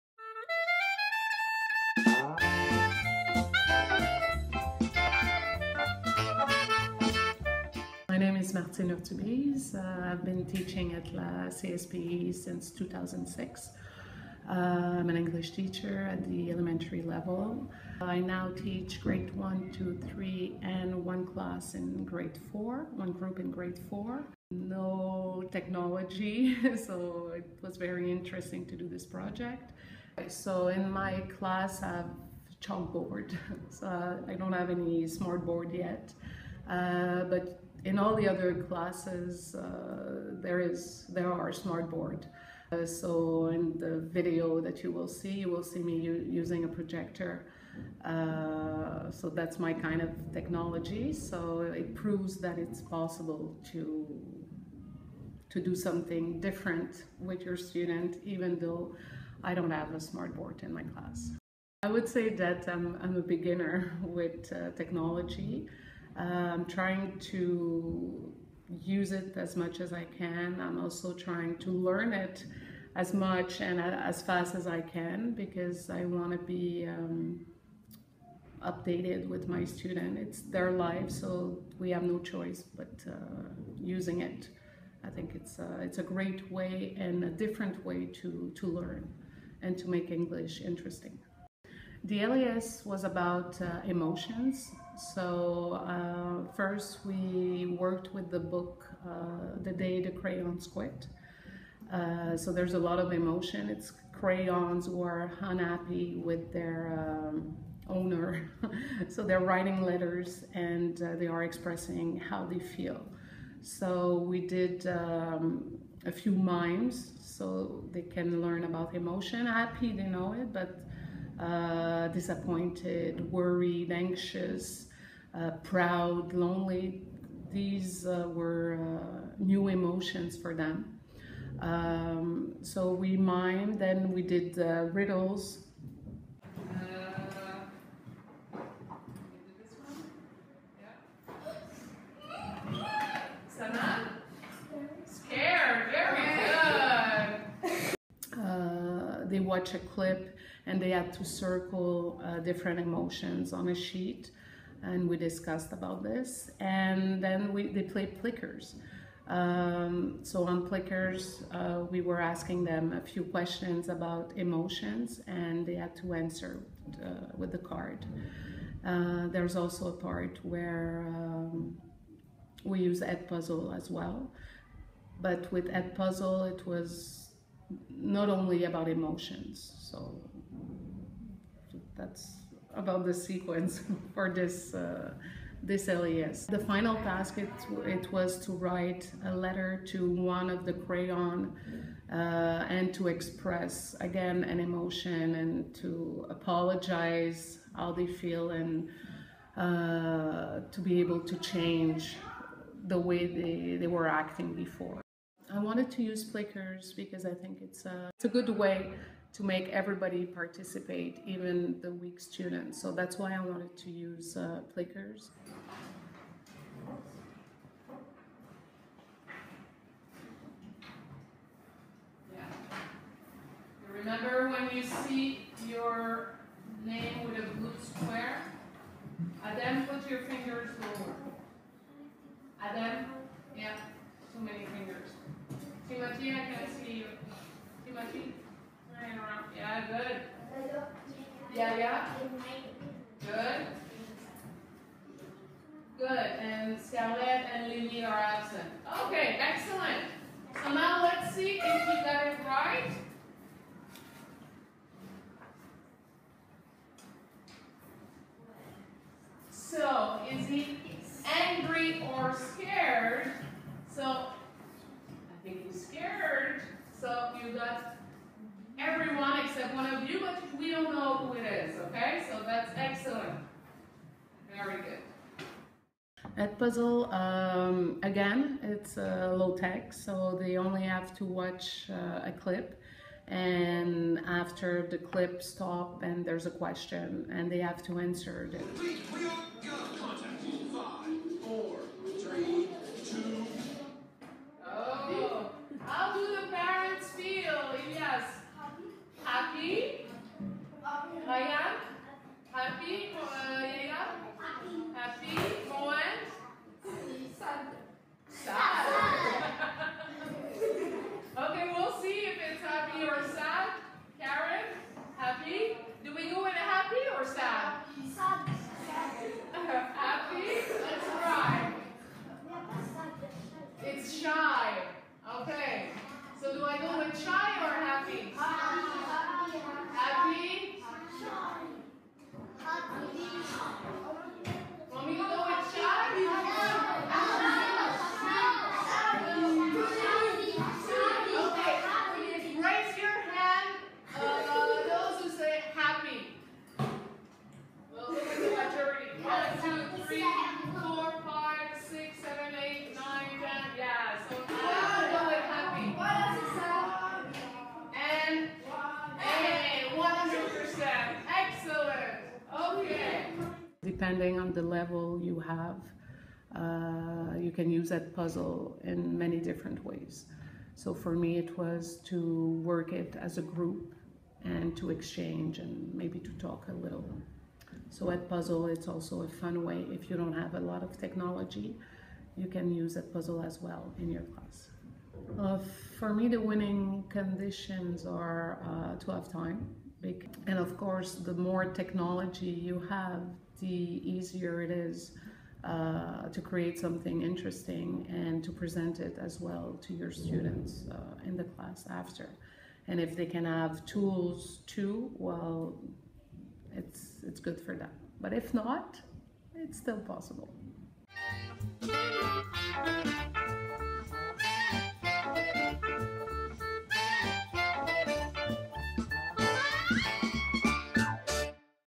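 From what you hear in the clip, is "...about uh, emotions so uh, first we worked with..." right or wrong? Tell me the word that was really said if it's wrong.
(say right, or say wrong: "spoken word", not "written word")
right.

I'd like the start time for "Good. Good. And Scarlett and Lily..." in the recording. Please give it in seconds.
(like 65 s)
243 s.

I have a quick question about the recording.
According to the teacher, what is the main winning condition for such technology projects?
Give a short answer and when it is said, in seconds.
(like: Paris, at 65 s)
To have time, at 389 s.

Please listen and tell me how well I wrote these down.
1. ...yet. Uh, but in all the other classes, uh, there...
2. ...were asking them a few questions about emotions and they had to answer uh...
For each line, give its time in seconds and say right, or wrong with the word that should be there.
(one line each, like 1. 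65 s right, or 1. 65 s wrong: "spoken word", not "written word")
1. 35 s right
2. 162 s right.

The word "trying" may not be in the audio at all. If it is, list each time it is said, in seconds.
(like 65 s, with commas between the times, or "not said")
66 s, 71 s.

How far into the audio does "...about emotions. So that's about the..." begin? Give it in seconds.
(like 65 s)
178 s.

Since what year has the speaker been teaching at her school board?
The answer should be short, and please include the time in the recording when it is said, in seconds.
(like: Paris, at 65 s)
2006, at 12 s.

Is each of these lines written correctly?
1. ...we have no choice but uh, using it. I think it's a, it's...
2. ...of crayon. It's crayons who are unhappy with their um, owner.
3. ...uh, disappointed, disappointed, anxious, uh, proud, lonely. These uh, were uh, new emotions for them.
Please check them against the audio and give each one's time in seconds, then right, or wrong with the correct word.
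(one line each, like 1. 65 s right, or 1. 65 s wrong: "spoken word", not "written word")
1. 81 s right
2. 102 s wrong: "emotion", not "crayon"
3. 121 s wrong: "worried", not "disappointed".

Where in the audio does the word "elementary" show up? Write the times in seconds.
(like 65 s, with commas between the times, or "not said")
16 s.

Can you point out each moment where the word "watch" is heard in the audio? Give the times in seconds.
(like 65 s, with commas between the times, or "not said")
149 s, 281 s.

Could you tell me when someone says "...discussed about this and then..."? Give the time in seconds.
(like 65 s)
155 s.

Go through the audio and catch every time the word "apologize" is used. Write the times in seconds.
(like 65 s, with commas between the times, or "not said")
196 s.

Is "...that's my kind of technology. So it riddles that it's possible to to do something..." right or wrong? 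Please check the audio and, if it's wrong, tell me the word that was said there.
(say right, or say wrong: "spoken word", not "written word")
wrong: "proves", not "riddles".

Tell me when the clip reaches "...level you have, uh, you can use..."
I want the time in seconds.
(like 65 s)
364 s.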